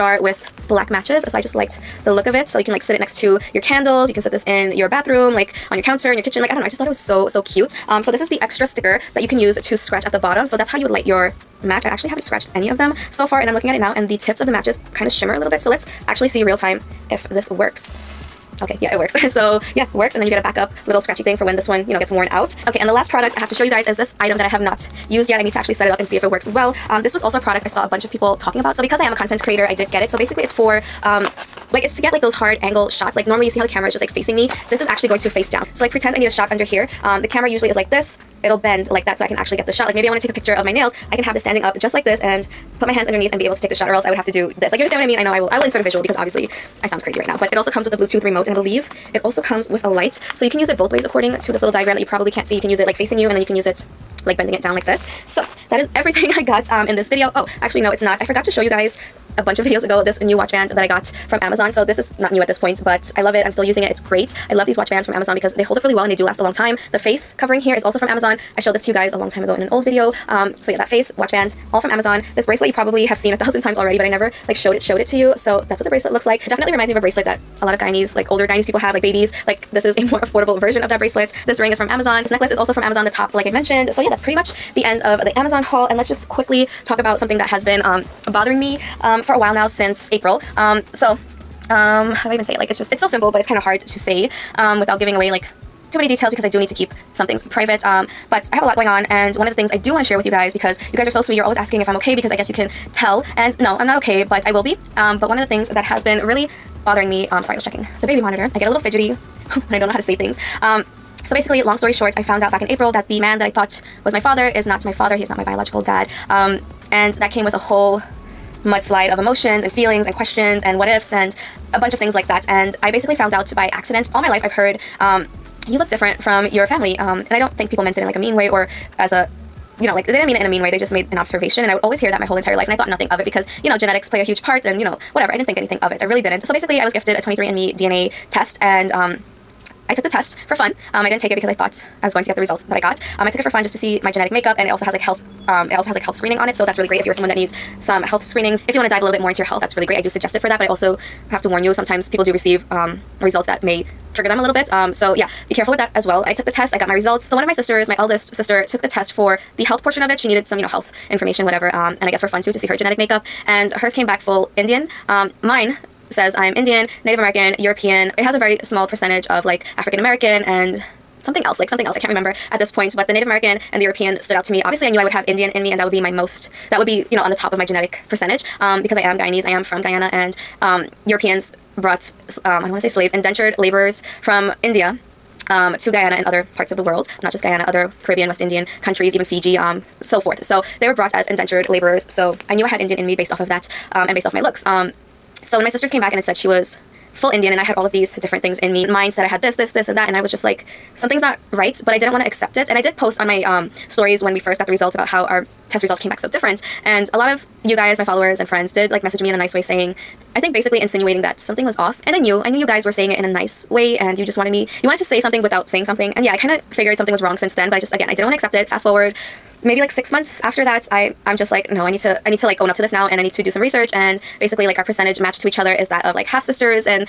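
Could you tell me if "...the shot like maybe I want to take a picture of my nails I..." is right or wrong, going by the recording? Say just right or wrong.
right.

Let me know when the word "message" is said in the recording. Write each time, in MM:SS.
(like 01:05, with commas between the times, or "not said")
03:29.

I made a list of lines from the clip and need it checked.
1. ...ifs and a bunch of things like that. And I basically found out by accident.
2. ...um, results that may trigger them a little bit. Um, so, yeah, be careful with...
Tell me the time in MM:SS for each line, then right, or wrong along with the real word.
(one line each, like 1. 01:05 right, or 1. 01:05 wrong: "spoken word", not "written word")
1. 02:00 right
2. 02:32 right.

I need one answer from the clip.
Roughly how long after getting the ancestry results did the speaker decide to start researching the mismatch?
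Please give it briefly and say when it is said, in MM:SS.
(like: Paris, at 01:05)
6 months, at 03:39.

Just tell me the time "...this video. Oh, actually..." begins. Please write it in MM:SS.
00:56.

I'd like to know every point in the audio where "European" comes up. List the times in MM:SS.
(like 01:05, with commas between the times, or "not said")
02:47, 02:53, 03:01.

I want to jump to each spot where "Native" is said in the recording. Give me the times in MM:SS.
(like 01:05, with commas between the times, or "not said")
02:47, 02:53.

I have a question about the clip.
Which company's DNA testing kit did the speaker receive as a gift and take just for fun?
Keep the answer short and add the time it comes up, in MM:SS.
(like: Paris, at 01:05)
23andMe, at 02:17.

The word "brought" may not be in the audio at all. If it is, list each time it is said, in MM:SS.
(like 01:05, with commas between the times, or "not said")
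03:01, 03:10.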